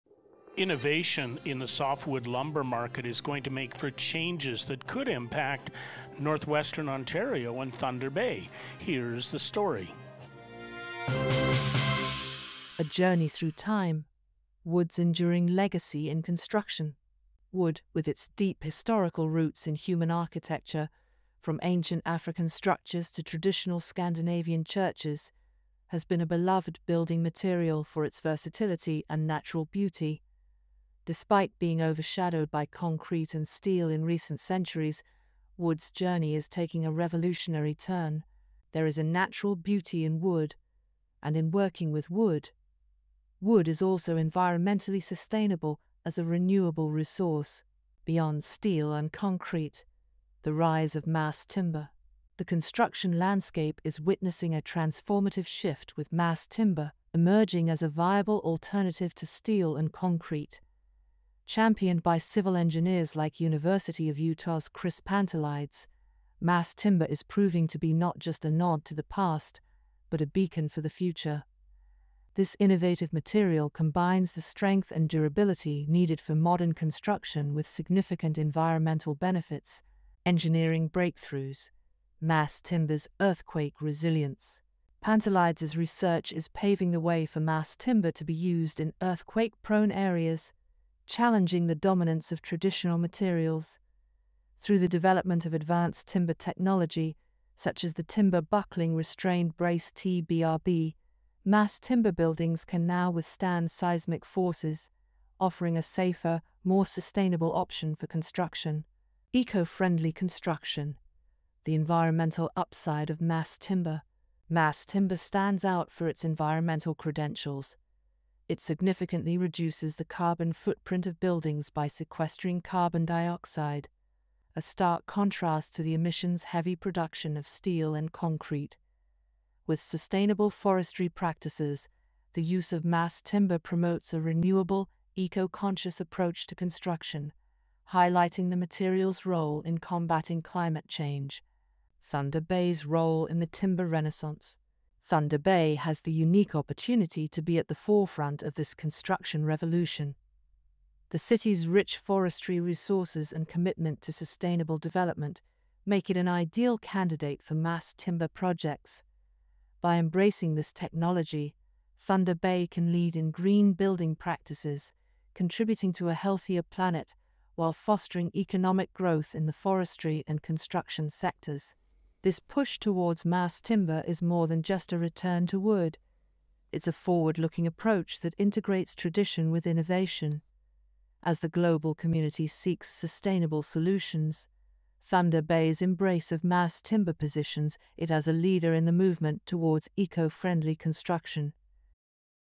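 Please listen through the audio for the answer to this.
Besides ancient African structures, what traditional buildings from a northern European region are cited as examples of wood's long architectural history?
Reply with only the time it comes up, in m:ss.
0:23.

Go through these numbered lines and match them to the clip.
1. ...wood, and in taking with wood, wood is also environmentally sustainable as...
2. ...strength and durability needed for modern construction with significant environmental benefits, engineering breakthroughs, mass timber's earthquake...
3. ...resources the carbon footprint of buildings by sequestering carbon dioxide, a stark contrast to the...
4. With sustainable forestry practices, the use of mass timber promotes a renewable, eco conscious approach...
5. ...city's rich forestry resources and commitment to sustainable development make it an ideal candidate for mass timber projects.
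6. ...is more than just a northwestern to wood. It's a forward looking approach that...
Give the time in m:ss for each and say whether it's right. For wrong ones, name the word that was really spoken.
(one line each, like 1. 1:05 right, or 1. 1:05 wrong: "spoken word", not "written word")
1. 0:40 wrong: "working", not "taking"
2. 1:14 right
3. 1:59 wrong: "reduces", not "resources"
4. 2:09 right
5. 2:31 right
6. 2:54 wrong: "return", not "northwestern".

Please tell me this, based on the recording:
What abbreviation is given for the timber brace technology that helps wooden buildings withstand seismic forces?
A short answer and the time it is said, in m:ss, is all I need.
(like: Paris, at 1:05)
TBRB, at 1:39.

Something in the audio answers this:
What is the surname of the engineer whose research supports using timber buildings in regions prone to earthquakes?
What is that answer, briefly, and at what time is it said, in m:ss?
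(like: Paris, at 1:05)
Pantelides, at 1:04.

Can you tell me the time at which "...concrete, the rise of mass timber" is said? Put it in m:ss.
0:49.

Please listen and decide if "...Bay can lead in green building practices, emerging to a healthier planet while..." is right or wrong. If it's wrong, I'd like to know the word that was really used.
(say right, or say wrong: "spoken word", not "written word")
wrong: "contributing", not "emerging".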